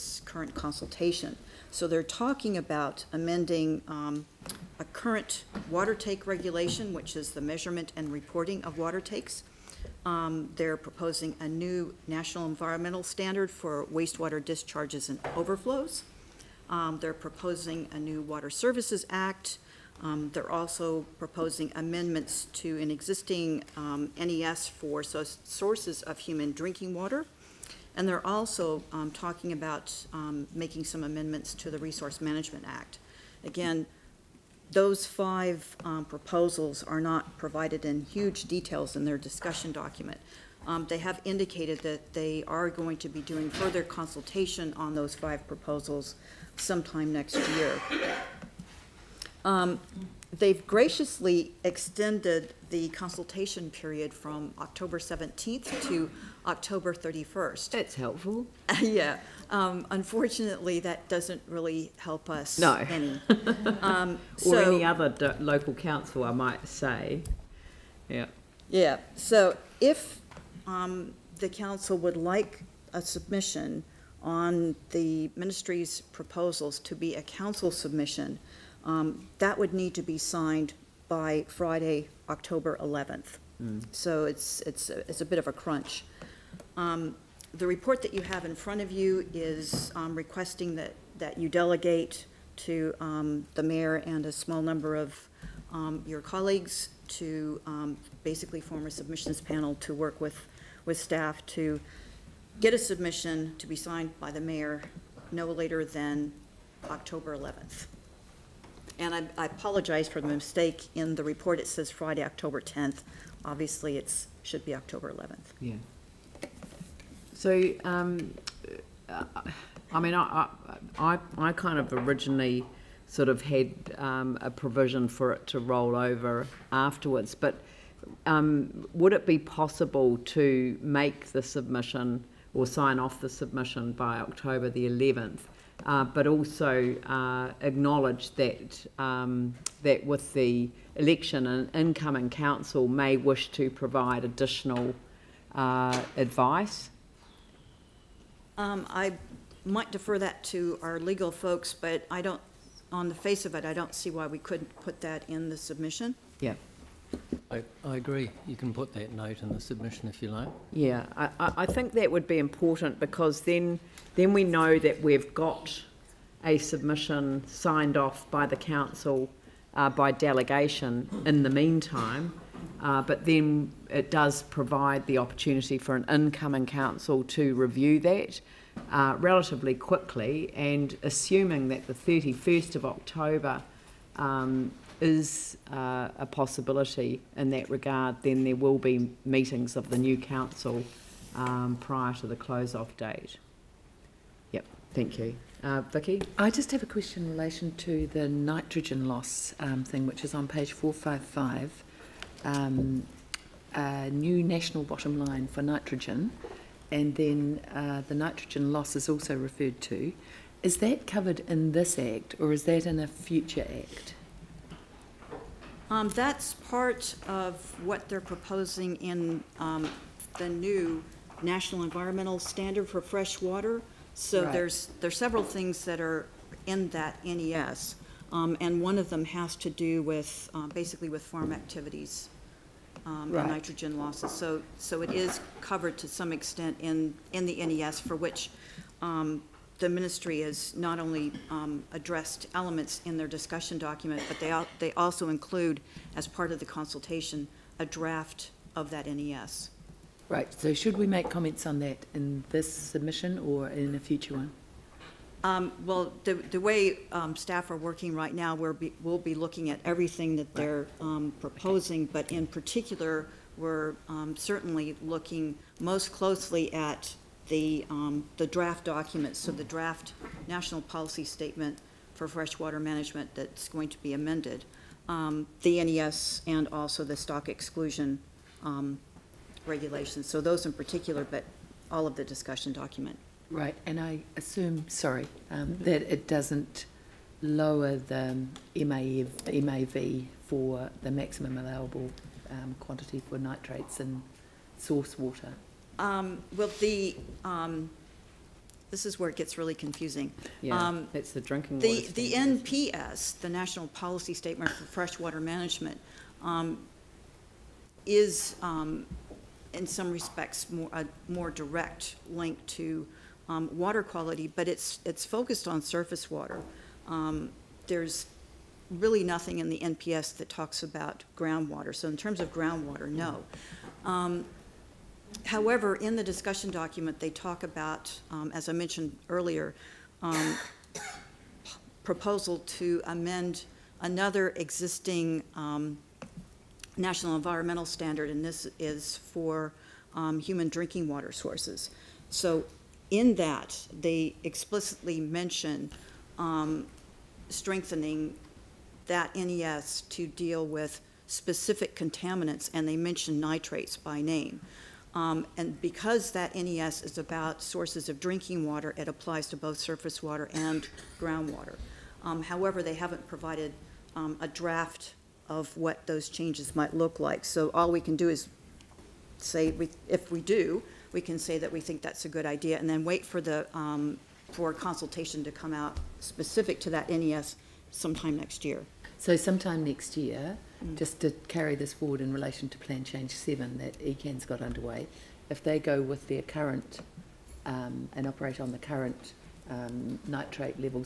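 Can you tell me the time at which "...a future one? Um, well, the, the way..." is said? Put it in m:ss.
4:13.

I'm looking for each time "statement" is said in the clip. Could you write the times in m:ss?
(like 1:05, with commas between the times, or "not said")
4:31, 5:04.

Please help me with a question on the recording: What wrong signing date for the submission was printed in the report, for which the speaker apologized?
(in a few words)
Friday, October 10th.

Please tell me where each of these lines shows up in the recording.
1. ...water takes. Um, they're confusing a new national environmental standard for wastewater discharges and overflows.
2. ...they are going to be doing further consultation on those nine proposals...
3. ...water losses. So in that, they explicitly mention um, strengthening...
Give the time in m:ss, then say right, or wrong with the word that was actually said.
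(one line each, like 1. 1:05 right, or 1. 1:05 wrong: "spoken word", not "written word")
1. 0:08 wrong: "proposing", not "confusing"
2. 0:42 wrong: "five", not "nine"
3. 5:41 wrong: "sources", not "losses".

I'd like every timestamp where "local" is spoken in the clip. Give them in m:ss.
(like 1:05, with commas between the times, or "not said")
1:05.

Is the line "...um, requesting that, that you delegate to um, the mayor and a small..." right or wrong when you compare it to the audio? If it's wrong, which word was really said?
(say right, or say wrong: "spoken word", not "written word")
right.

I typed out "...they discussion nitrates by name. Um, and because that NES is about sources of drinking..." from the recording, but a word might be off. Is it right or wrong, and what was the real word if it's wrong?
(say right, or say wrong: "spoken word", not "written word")
wrong: "mention", not "discussion".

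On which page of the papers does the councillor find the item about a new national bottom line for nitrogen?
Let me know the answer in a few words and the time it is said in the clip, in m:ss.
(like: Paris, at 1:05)
Page 455, at 3:20.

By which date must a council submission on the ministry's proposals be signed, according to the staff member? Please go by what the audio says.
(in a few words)
Friday, October 11th.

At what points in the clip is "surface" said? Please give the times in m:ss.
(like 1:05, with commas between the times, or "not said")
5:15, 5:59.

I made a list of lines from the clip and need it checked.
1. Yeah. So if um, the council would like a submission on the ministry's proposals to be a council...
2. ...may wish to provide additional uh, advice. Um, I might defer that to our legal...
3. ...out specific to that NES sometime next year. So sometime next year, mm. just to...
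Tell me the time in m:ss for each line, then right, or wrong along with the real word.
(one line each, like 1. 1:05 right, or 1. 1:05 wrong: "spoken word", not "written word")
1. 1:08 right
2. 2:22 right
3. 6:15 right.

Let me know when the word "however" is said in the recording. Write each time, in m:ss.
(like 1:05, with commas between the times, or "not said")
5:25, 6:02.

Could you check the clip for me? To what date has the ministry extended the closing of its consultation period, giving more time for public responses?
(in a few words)
October 31st.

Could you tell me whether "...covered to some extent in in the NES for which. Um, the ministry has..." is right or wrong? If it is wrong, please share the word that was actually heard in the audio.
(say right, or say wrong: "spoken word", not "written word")
right.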